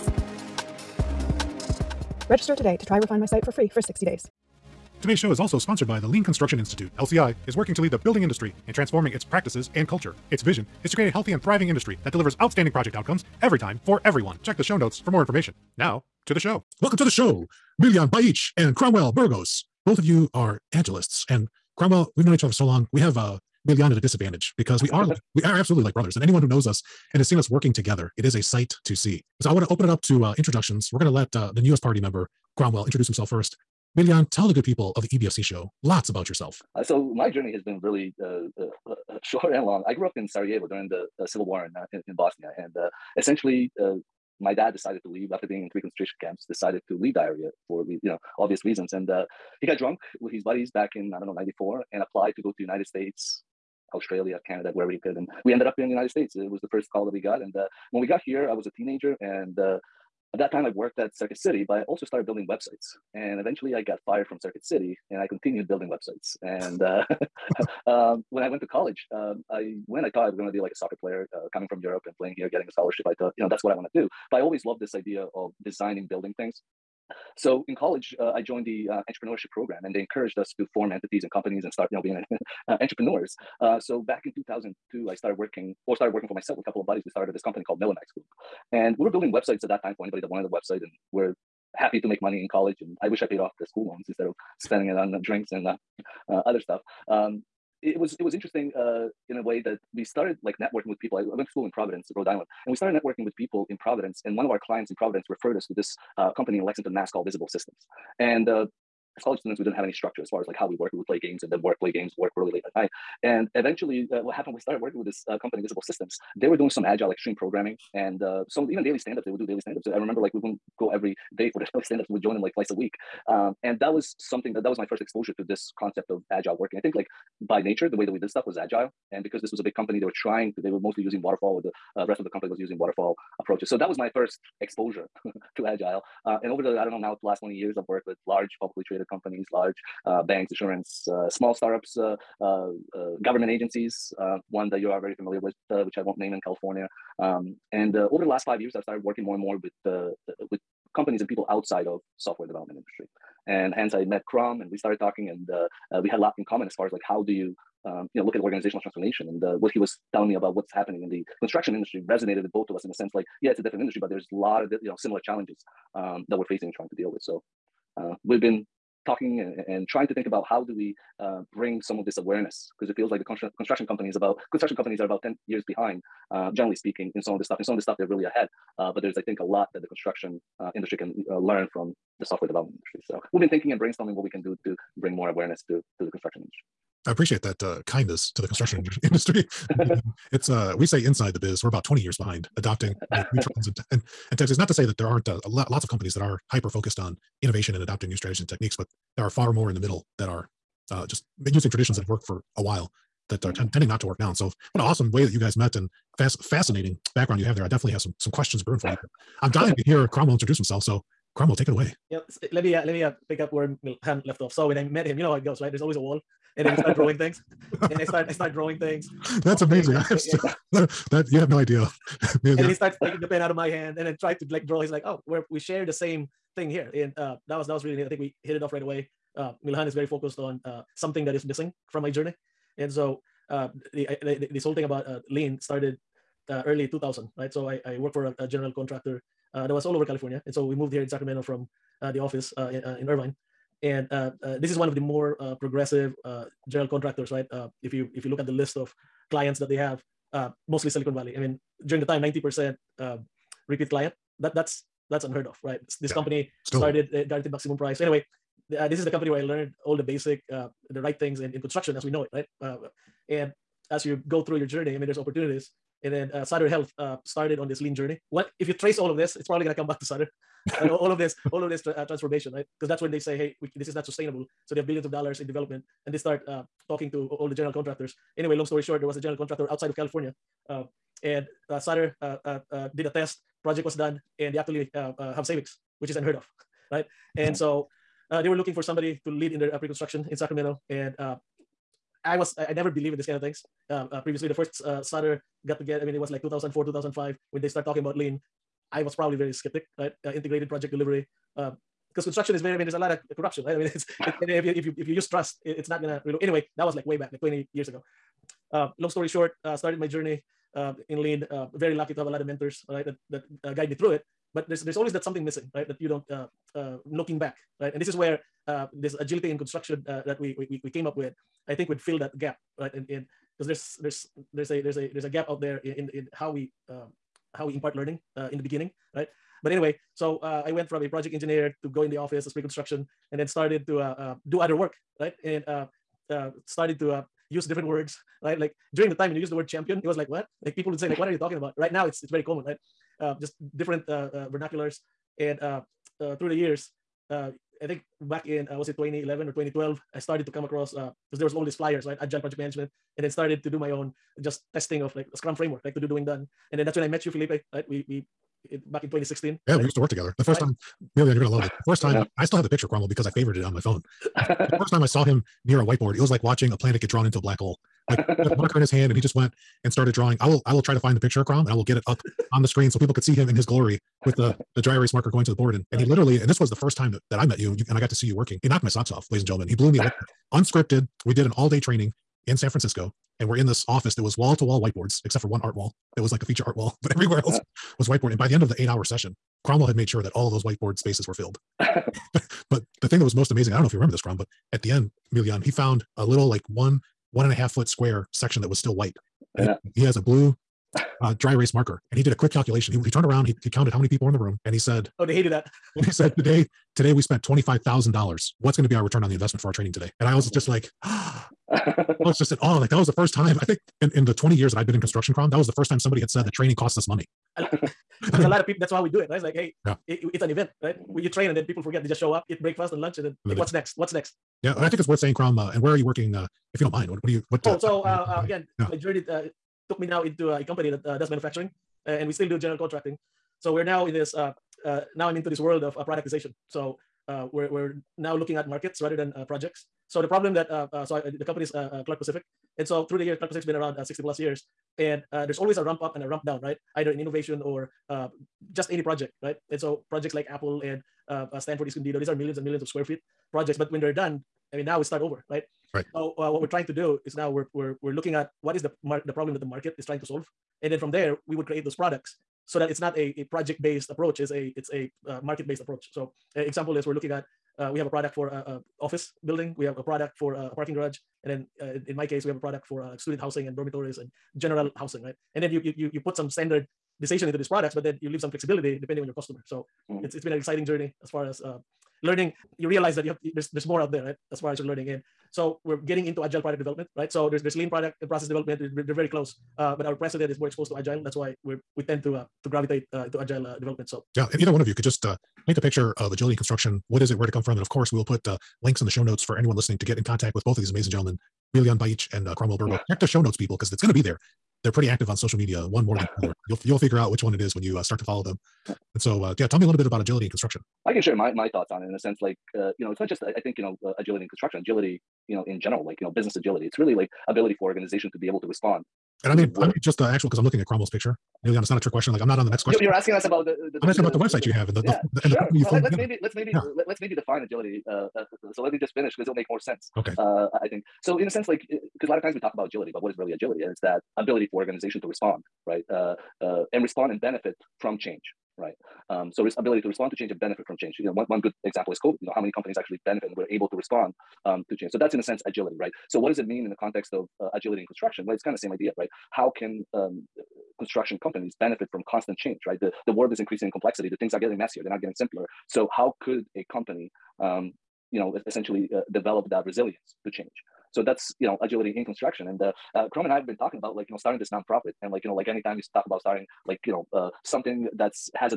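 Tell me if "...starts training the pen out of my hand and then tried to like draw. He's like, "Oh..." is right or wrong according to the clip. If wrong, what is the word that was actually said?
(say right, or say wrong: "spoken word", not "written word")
wrong: "taking", not "training".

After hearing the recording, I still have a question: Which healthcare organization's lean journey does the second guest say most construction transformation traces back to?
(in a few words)
Sutter Health.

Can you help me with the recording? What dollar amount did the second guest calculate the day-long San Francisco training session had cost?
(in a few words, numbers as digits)
$25,000.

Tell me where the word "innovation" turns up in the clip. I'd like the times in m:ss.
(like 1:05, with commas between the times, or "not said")
3:17, 7:27.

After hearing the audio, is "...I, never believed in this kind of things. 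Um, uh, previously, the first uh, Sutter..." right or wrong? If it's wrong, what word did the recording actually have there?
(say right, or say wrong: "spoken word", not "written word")
right.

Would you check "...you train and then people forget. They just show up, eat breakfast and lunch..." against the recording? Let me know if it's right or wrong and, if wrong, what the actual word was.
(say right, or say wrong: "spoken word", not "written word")
right.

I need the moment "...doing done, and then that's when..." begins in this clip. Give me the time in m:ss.
5:56.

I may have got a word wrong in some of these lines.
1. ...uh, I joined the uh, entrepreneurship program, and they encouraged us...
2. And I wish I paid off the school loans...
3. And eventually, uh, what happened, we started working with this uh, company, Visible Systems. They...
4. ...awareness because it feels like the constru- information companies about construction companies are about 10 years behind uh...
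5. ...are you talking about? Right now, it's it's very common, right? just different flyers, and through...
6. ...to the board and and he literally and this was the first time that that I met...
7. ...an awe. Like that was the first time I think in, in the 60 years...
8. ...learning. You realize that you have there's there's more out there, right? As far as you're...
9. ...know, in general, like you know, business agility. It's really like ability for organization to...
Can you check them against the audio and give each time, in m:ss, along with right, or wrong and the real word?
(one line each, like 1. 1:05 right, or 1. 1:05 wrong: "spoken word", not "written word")
1. 1:18 right
2. 1:32 right
3. 1:53 right
4. 2:52 wrong: "construction", not "information"
5. 5:41 wrong: "vernaculars", not "flyers"
6. 6:15 right
7. 6:52 wrong: "20", not "60"
8. 8:02 right
9. 8:35 right.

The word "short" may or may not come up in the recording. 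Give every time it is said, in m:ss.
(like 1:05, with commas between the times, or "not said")
0:39, 4:38, 5:09.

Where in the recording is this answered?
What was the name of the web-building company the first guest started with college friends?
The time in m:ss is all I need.
1:27.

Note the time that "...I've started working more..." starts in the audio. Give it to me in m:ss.
2:28.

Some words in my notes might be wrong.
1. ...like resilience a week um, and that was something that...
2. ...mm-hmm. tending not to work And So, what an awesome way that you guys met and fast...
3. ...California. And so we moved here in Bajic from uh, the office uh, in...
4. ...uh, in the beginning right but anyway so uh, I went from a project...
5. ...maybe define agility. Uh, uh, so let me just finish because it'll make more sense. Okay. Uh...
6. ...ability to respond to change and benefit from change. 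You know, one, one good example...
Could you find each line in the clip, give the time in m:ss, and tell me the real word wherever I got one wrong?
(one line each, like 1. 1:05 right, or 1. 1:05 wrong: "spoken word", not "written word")
1. 2:02 wrong: "twice", not "resilience"
2. 3:23 right
3. 4:00 wrong: "Sacramento", not "Bajic"
4. 5:28 right
5. 8:47 right
6. 8:59 right.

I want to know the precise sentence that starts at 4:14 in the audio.
That that's that's unheard of, right?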